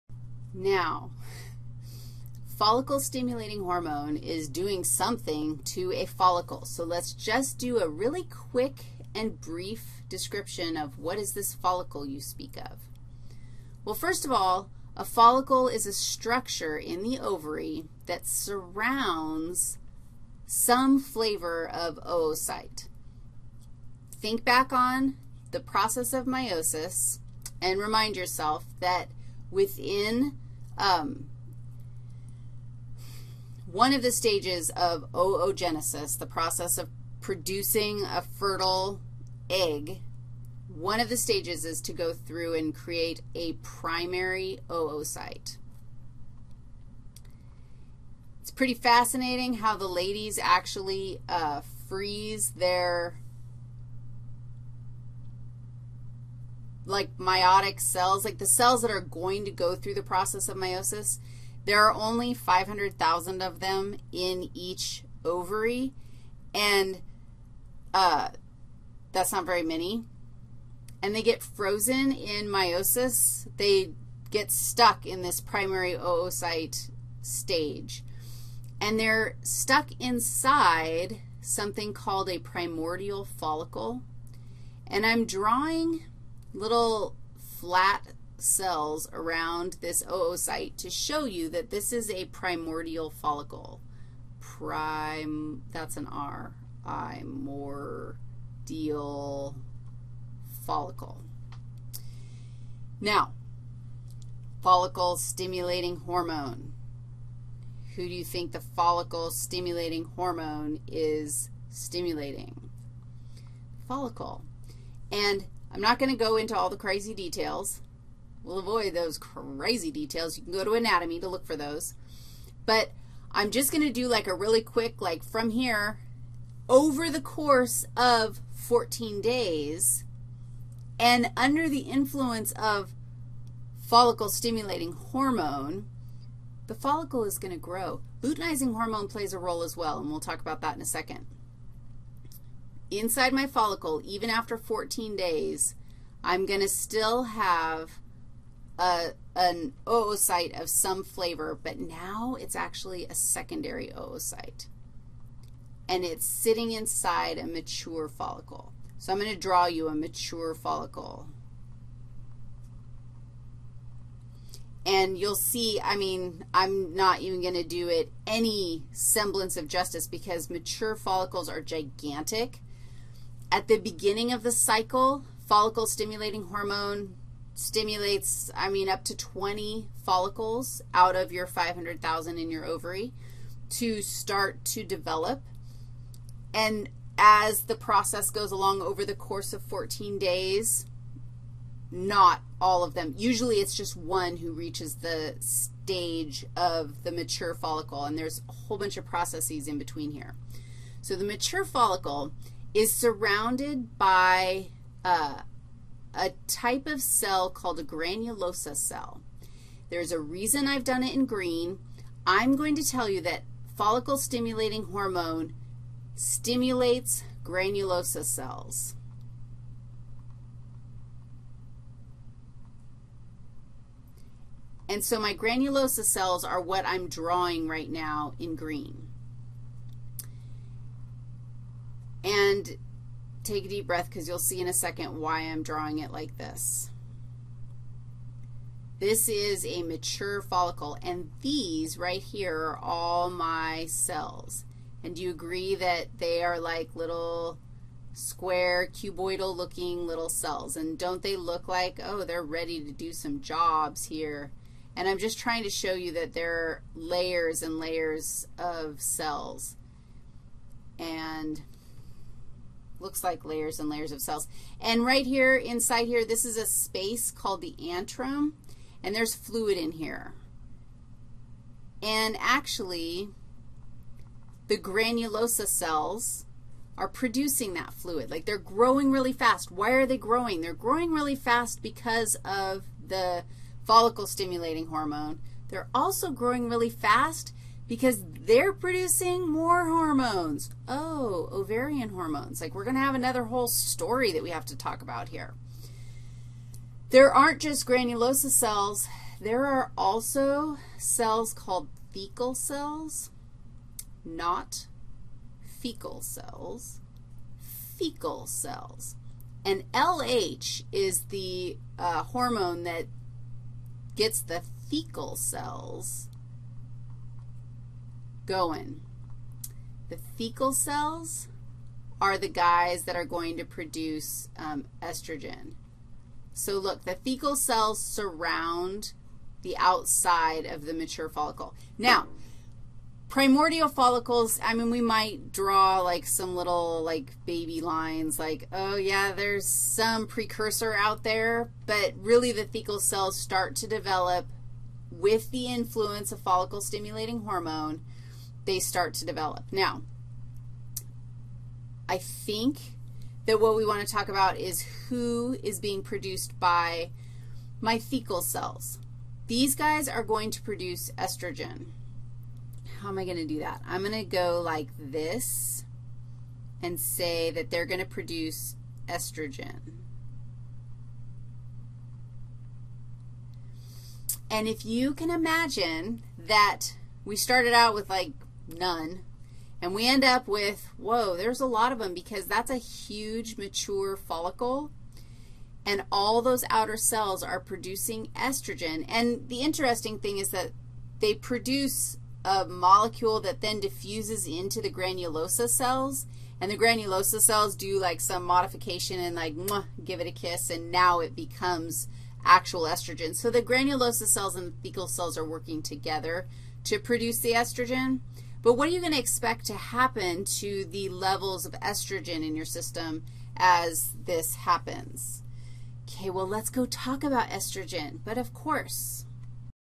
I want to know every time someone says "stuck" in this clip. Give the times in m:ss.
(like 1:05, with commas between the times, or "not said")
1:14, 1:19.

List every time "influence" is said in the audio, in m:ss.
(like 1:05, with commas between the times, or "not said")
2:11, 5:45.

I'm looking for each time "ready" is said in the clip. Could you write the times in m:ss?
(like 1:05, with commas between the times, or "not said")
4:12.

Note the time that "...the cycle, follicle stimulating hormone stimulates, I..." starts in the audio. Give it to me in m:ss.
2:54.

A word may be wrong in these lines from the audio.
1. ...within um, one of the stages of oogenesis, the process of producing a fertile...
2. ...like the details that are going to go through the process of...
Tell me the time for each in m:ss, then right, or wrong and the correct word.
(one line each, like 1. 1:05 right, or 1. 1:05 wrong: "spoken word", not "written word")
1. 0:29 right
2. 0:58 wrong: "cells", not "details".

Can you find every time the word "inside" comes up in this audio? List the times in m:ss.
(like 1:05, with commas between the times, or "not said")
1:19, 2:22, 2:36, 4:25.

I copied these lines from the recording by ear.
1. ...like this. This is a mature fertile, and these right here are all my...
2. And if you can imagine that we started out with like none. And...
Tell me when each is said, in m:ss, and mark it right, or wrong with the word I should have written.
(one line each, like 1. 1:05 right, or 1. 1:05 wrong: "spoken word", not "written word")
1. 3:56 wrong: "follicle", not "fertile"
2. 6:14 right.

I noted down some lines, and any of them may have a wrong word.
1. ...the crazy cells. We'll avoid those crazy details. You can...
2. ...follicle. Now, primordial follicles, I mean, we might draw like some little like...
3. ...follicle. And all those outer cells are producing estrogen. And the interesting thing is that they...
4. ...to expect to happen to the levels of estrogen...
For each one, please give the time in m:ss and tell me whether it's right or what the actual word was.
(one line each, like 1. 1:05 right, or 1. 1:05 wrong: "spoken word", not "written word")
1. 1:56 wrong: "details", not "cells"
2. 5:31 right
3. 6:24 right
4. 6:49 right.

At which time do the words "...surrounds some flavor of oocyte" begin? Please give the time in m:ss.
0:18.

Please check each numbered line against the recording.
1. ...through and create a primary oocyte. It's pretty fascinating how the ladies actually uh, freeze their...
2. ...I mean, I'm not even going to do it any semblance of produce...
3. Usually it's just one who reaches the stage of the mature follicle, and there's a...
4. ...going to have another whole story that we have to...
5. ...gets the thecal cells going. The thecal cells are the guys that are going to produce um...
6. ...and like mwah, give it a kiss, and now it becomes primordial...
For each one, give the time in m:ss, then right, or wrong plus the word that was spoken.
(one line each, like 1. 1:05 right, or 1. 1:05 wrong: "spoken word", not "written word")
1. 0:42 right
2. 2:45 wrong: "justice", not "produce"
3. 3:13 right
4. 4:52 right
5. 5:14 right
6. 6:39 wrong: "actual", not "primordial".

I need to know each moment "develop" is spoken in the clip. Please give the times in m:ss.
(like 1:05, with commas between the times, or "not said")
3:04, 5:43, 5:49.